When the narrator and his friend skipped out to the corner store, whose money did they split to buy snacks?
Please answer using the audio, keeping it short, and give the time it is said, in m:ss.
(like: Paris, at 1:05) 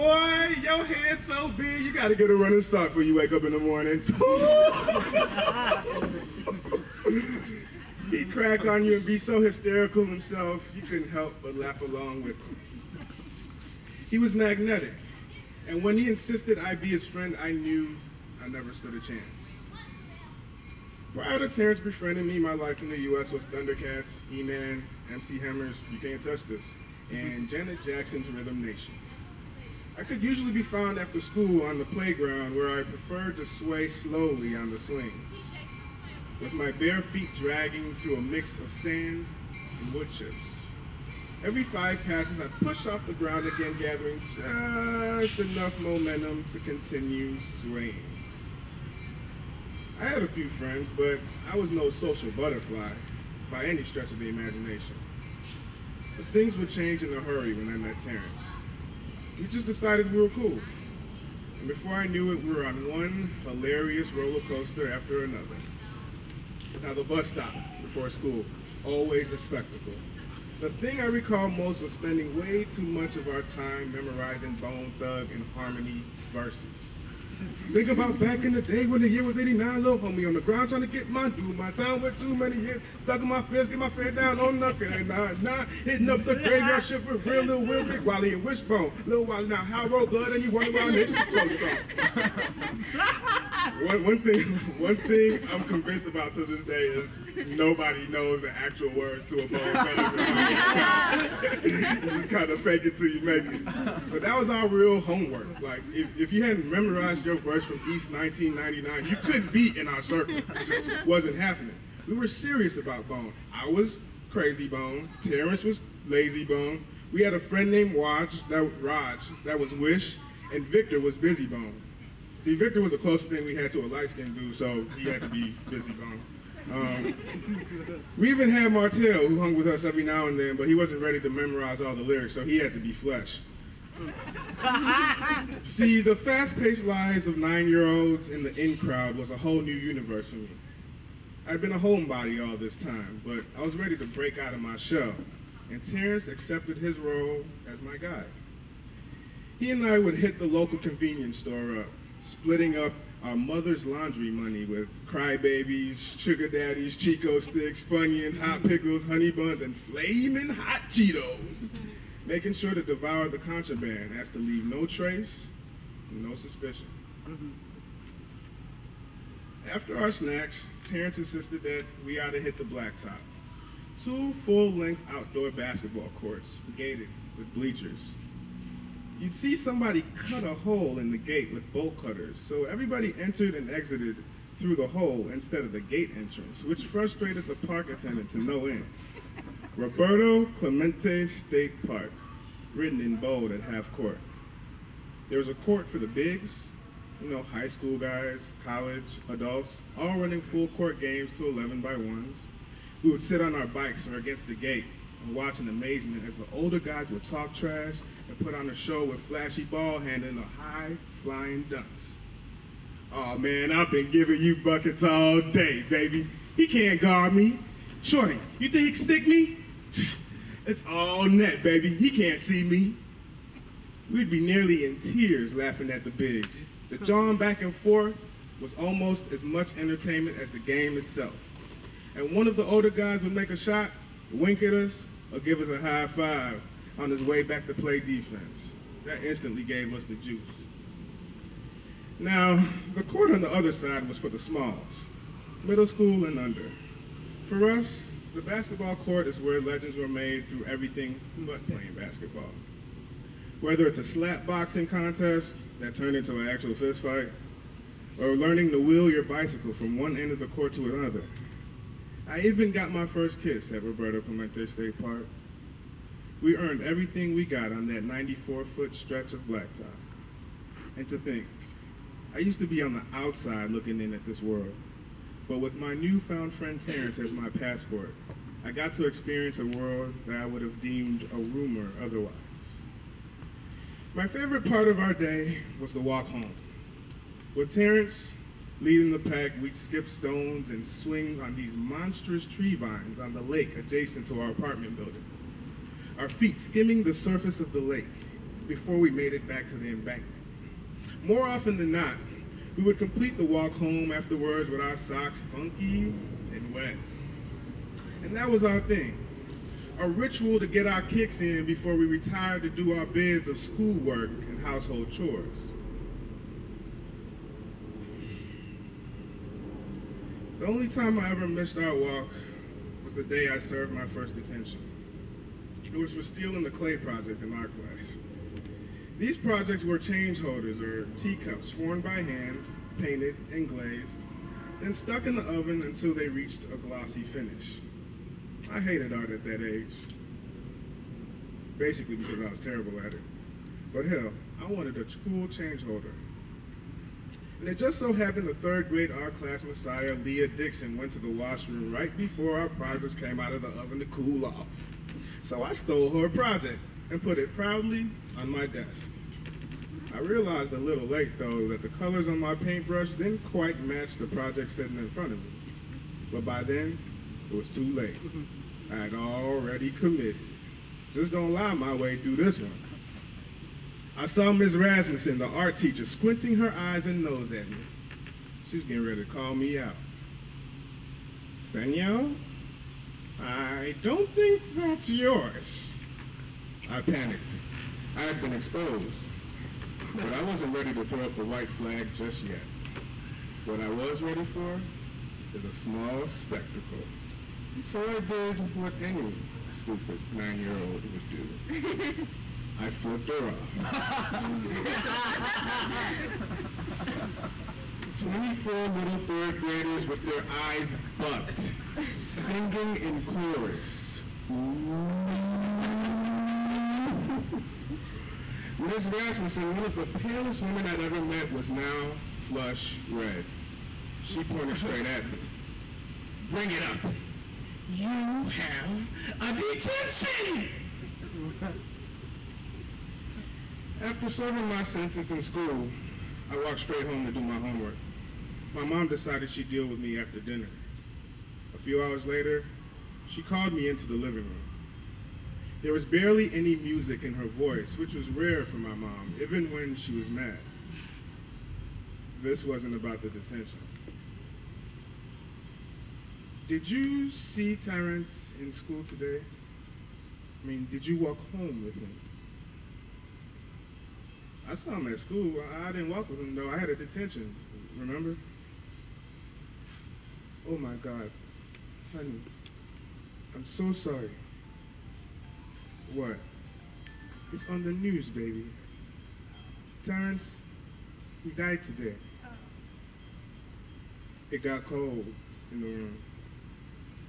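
mother's laundry money, at 2:33.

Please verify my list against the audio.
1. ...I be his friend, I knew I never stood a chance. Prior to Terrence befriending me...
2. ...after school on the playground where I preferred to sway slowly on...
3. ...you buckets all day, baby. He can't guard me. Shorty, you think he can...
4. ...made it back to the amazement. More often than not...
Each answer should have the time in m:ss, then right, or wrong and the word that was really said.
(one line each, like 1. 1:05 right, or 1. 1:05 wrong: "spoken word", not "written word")
1. 0:16 right
2. 0:30 right
3. 3:34 right
4. 4:59 wrong: "embankment", not "amazement".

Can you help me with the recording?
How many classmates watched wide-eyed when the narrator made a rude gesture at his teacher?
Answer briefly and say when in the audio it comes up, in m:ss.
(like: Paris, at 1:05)
24, at 6:48.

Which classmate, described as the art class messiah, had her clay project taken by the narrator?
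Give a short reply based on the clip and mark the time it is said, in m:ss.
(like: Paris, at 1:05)
Leah Dixon, at 5:50.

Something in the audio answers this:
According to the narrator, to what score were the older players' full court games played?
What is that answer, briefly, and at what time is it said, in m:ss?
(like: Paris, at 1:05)
11, at 3:21.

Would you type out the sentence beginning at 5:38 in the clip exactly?
I hated art at that age, basically because I was terrible at it.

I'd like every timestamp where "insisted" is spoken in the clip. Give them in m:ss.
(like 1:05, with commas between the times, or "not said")
0:16, 2:51.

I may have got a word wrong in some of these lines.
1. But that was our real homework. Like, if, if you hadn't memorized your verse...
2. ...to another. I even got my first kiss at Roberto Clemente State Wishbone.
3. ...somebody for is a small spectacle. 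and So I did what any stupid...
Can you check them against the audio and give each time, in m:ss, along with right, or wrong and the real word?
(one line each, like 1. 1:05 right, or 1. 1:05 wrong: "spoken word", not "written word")
1. 1:44 right
2. 4:20 wrong: "Park", not "Wishbone"
3. 6:34 wrong: "ready", not "somebody".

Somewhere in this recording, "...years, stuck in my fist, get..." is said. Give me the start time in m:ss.
1:22.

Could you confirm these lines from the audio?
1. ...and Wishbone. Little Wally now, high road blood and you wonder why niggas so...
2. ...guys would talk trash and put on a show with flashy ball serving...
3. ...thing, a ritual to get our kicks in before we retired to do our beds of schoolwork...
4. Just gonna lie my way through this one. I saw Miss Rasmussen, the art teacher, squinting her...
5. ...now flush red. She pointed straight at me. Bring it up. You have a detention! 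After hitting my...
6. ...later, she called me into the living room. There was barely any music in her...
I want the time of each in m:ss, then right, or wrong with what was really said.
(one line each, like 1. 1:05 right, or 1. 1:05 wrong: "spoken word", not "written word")
1. 1:28 right
2. 3:26 wrong: "handling", not "serving"
3. 5:08 right
4. 6:11 right
5. 7:01 wrong: "serving", not "hitting"
6. 7:22 right.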